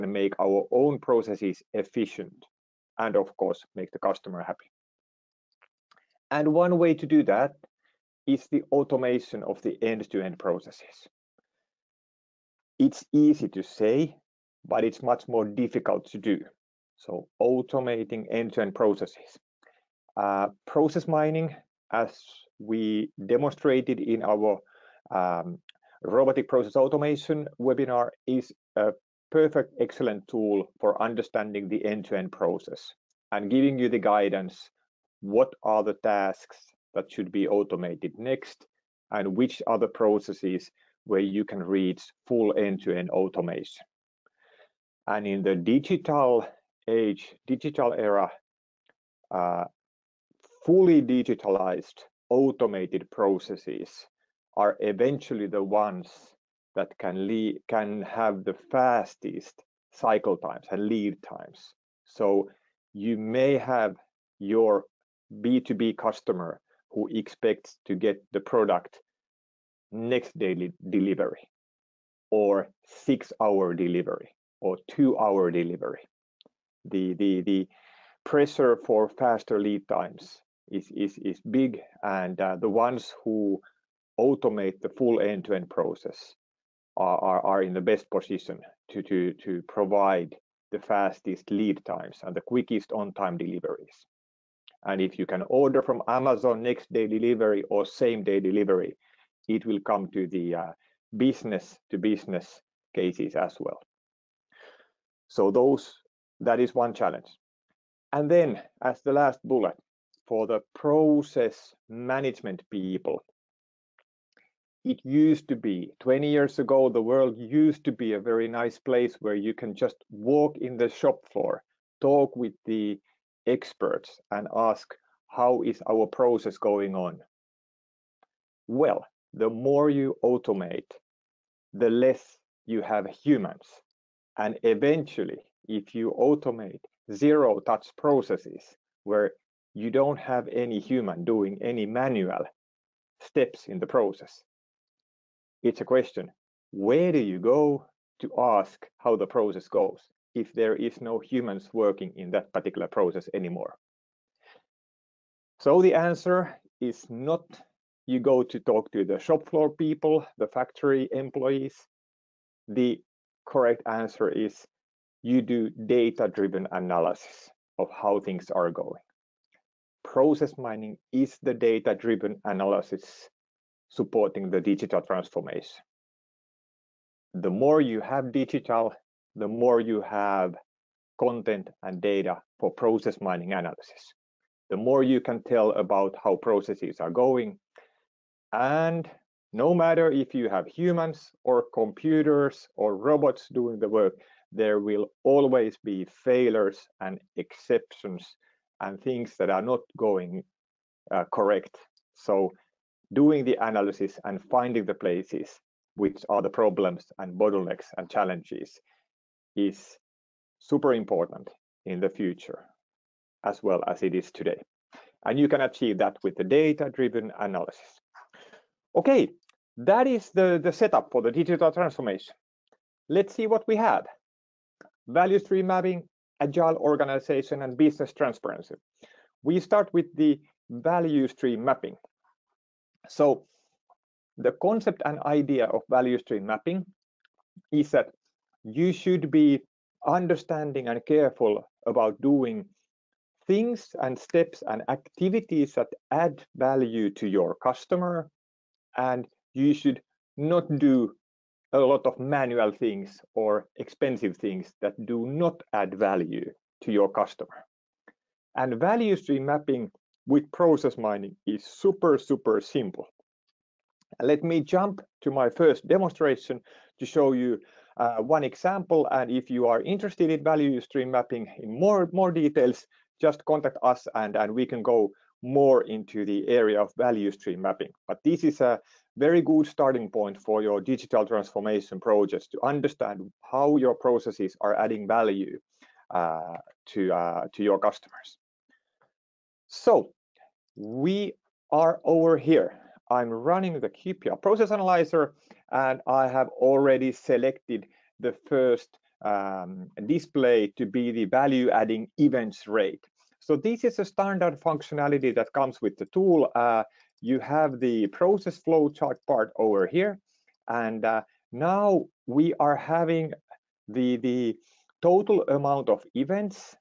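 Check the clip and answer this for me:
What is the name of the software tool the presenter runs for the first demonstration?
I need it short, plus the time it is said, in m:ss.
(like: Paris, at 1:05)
QPR Process Analyzer, at 4:53.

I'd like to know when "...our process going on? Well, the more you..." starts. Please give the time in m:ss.
2:05.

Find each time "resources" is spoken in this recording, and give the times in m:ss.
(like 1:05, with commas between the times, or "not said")
not said.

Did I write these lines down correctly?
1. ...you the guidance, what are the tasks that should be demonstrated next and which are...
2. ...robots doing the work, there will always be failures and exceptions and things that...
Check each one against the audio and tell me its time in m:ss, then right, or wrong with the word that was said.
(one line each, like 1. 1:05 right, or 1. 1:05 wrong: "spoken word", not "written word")
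1. 0:33 wrong: "automated", not "demonstrated"
2. 3:12 right.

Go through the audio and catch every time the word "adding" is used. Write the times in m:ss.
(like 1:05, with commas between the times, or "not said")
4:44, 5:01.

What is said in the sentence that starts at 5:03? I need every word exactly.
So this is a standard functionality that comes with the tool.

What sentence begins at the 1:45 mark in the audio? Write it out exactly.
So those that is one challenge.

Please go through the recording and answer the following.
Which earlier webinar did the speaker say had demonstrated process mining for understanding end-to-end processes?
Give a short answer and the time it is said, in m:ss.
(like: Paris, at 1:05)
Robotic process automation, at 0:26.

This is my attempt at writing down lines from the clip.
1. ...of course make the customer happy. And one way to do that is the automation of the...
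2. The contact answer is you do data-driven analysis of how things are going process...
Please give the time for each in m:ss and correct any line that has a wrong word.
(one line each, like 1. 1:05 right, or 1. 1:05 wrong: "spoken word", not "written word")
1. 0:03 right
2. 2:42 wrong: "correct", not "contact".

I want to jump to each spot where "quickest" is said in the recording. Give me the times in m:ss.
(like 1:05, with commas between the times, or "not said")
1:32.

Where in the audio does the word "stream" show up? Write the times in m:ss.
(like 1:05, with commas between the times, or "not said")
3:45, 3:51, 3:56, 4:19, 4:30, 4:37.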